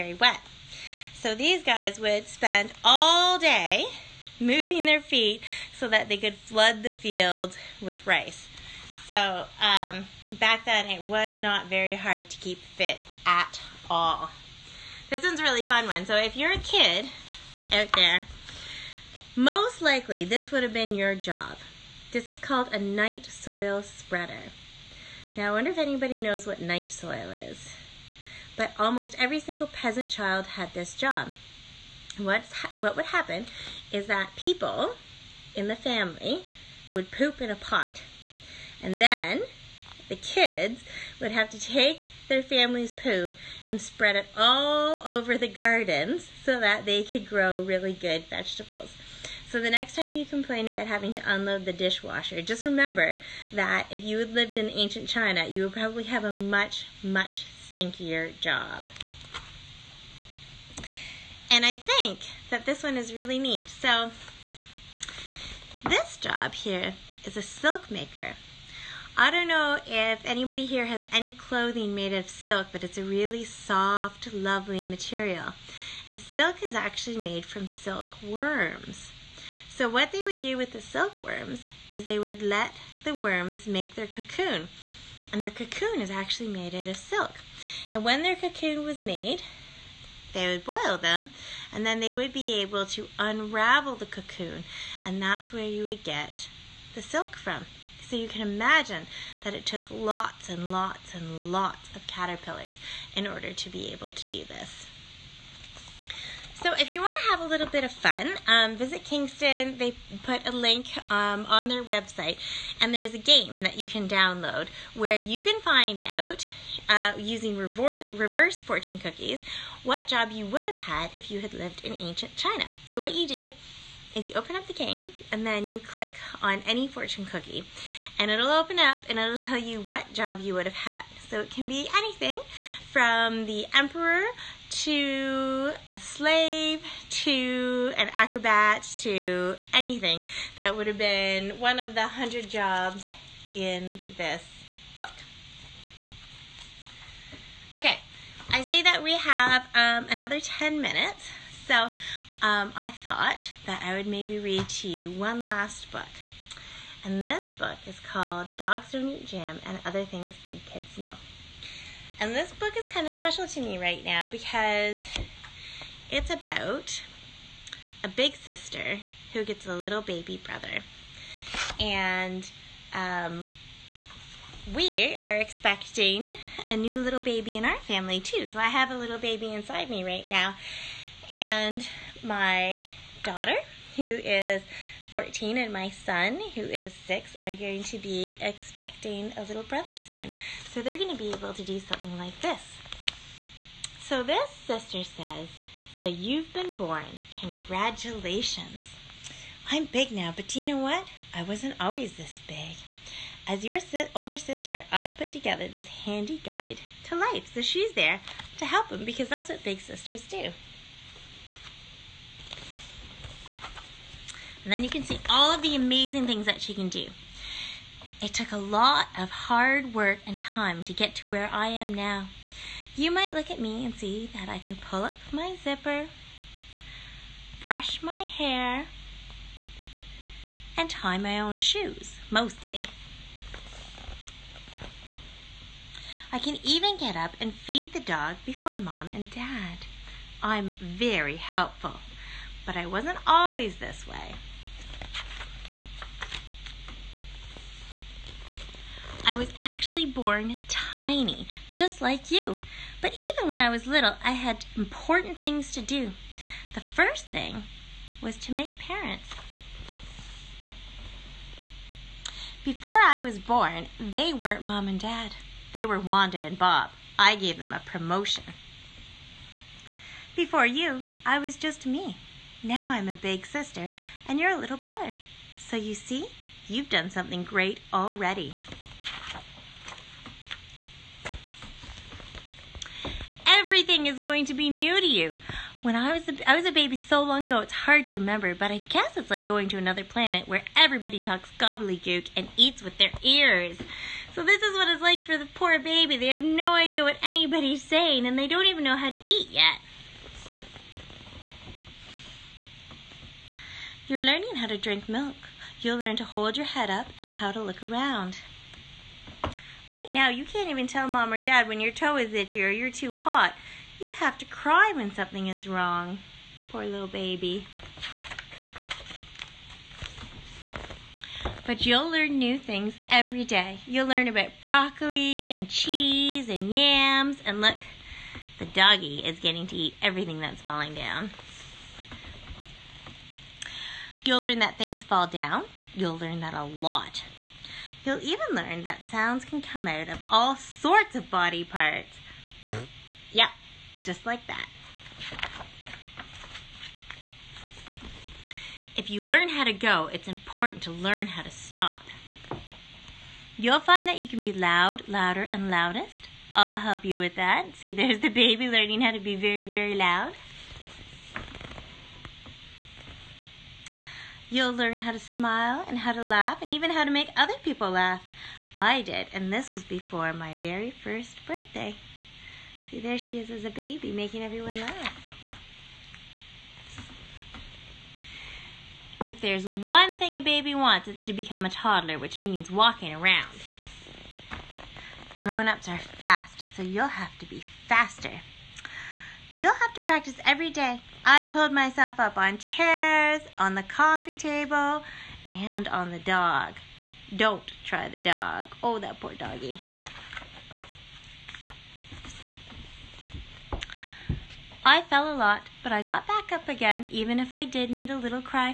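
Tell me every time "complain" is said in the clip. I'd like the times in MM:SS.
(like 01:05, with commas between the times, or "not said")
00:50.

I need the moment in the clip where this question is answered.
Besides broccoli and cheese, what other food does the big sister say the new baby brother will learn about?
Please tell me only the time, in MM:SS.
05:26.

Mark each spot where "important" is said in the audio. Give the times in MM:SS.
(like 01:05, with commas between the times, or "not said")
04:14, 05:50.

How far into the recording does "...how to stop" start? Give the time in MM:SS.
05:51.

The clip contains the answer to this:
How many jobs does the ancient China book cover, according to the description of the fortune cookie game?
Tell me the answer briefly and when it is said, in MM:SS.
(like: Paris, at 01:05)
100, at 02:22.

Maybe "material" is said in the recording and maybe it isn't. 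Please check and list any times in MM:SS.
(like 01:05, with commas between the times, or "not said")
01:14.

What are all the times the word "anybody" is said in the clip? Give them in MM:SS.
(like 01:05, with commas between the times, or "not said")
00:25, 01:10, 04:57.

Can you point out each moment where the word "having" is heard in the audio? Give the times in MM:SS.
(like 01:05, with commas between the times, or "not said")
00:50.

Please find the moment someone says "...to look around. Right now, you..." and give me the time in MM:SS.
05:07.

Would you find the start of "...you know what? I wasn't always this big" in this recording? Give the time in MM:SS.
03:20.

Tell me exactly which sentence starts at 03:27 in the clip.
So she's there to help him because that's what big sisters do.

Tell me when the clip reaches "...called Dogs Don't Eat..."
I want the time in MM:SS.
02:37.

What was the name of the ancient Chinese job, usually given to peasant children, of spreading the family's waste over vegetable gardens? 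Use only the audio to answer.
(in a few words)
Night soil spreader.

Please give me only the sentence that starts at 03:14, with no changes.
So this sister says, So you've been born.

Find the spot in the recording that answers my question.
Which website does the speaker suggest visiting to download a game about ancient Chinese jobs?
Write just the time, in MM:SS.
01:49.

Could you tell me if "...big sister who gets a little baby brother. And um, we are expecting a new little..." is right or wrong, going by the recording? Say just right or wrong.
right.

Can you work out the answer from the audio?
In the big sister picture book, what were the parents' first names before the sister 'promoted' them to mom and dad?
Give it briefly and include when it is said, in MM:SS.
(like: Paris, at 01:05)
Wanda and Bob, at 04:25.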